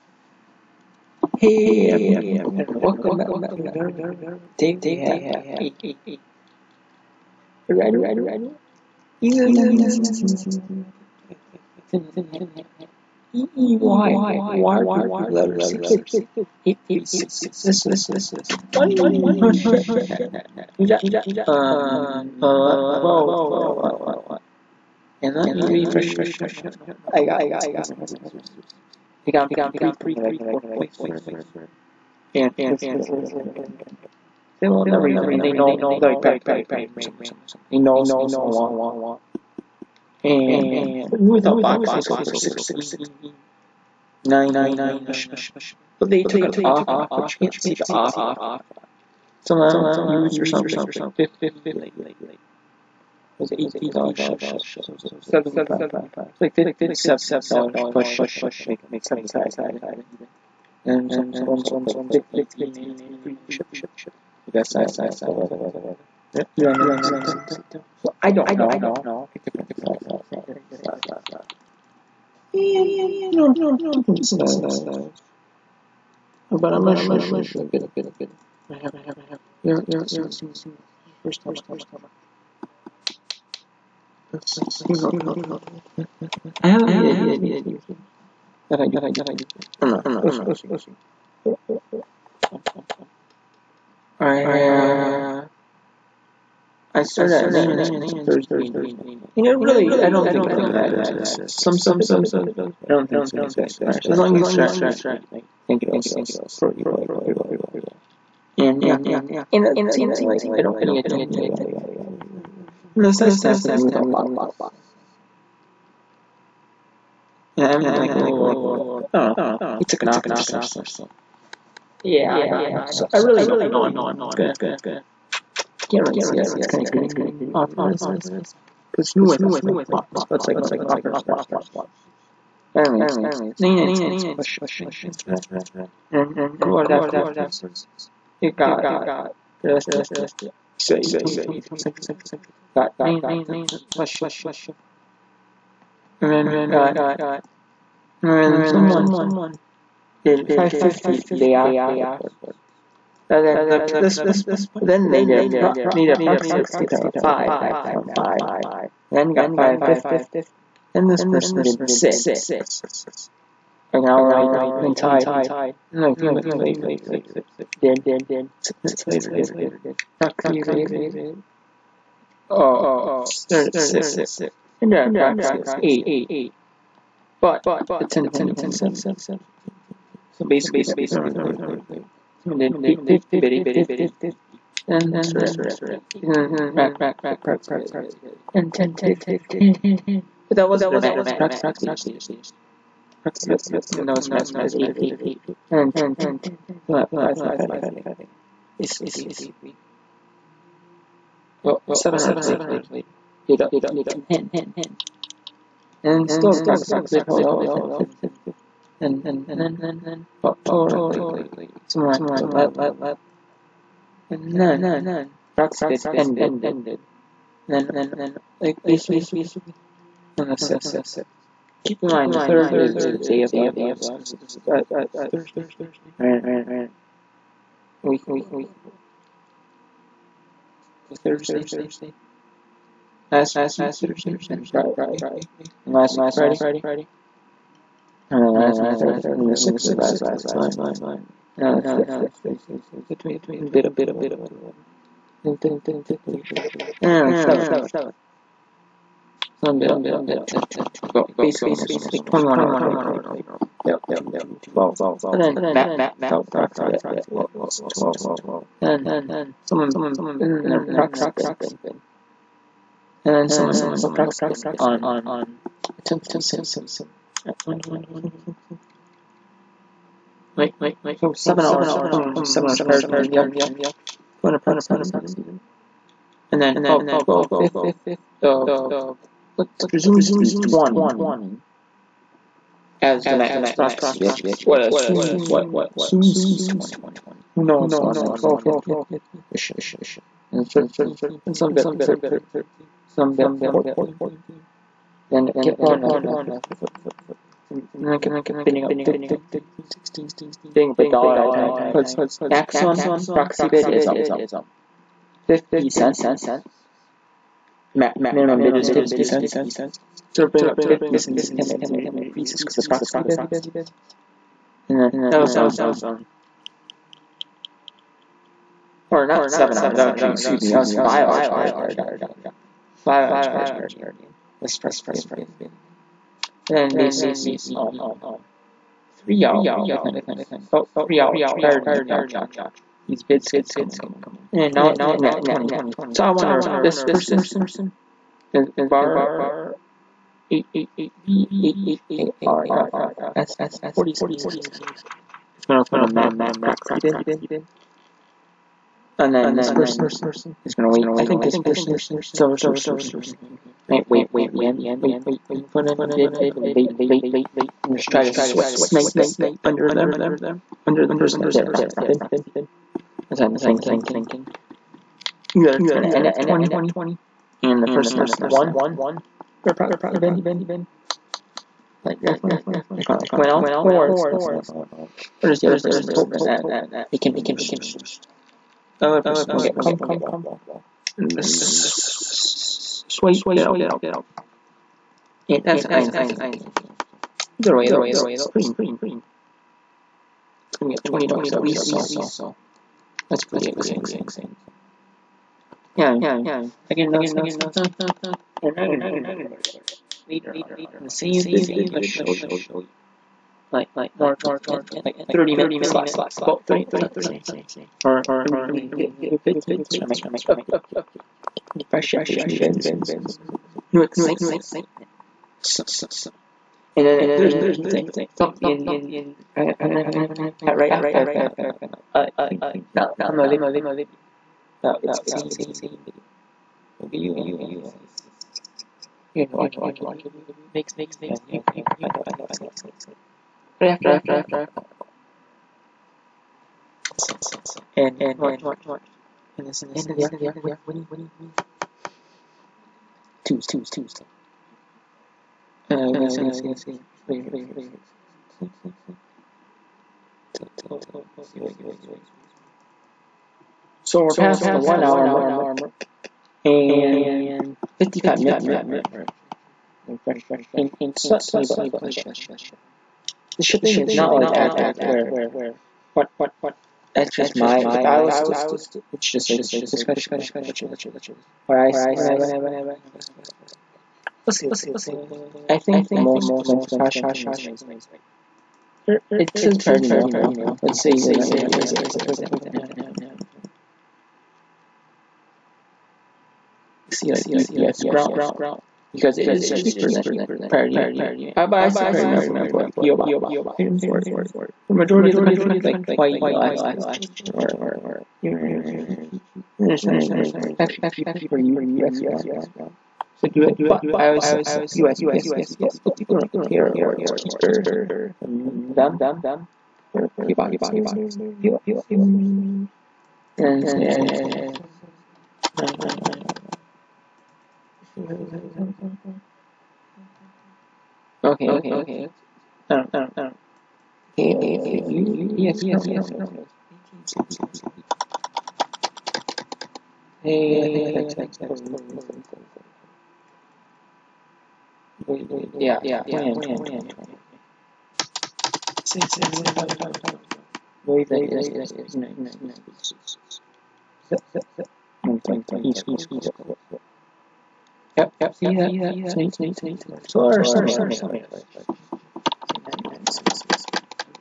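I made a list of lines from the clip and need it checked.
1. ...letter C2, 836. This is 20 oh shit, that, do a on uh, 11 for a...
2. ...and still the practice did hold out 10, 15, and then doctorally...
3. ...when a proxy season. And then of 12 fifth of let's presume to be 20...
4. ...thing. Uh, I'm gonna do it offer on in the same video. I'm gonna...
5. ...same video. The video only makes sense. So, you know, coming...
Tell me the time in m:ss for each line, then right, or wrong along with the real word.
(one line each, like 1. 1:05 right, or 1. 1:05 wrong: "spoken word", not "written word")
1. 0:15 wrong: "12", not "11"
2. 3:26 right
3. 4:34 right
4. 6:37 wrong: "later", not "offer"
5. 7:05 wrong: "watching", not "coming".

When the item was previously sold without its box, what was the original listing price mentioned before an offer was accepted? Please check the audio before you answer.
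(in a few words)
$169.99.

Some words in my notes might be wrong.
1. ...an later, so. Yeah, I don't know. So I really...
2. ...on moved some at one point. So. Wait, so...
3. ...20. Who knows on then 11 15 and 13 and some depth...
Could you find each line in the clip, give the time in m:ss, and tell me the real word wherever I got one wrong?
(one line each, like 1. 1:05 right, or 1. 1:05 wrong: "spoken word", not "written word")
1. 2:00 wrong: "offer", not "later"
2. 4:24 wrong: "attempted", not "moved"
3. 4:46 wrong: "12", not "11".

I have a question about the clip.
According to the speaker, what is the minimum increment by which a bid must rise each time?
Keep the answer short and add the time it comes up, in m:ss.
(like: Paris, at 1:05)
50 cents, at 5:07.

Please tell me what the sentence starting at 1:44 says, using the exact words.
As long as you start at night, I think it'll pretty well, pretty well.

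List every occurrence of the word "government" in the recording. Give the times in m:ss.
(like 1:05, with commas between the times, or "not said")
not said.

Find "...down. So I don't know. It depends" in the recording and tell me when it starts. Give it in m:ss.
1:07.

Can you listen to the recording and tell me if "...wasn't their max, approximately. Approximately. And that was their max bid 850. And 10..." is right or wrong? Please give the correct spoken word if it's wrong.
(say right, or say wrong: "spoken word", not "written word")
right.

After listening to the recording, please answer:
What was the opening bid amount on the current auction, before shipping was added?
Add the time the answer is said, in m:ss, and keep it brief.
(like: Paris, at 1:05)
99 cents, at 2:13.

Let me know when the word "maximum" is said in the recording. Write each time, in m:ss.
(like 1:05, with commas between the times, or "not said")
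2:37, 5:02.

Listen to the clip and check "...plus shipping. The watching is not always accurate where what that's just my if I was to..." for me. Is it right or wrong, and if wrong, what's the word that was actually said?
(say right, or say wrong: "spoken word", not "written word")
wrong: "shipping", not "watching".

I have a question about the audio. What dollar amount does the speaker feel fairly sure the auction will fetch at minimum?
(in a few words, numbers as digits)
20 bucks.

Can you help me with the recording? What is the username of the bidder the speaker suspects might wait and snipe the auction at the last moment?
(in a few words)
Silver Surfer 16.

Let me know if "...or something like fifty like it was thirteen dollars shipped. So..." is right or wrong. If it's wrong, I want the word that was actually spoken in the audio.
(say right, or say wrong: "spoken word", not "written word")
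wrong: "eighteen", not "thirteen".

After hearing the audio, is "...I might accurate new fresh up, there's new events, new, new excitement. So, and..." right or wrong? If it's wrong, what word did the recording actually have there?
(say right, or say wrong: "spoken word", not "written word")
wrong: "update", not "accurate".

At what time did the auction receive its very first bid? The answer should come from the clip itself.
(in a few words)
8:23 Central Time.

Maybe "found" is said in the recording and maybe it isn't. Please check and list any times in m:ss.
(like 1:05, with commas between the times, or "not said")
7:00, 7:14.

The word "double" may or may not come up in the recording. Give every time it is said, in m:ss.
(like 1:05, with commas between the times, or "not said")
not said.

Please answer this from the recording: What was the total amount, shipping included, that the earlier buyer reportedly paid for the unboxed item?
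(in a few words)
75.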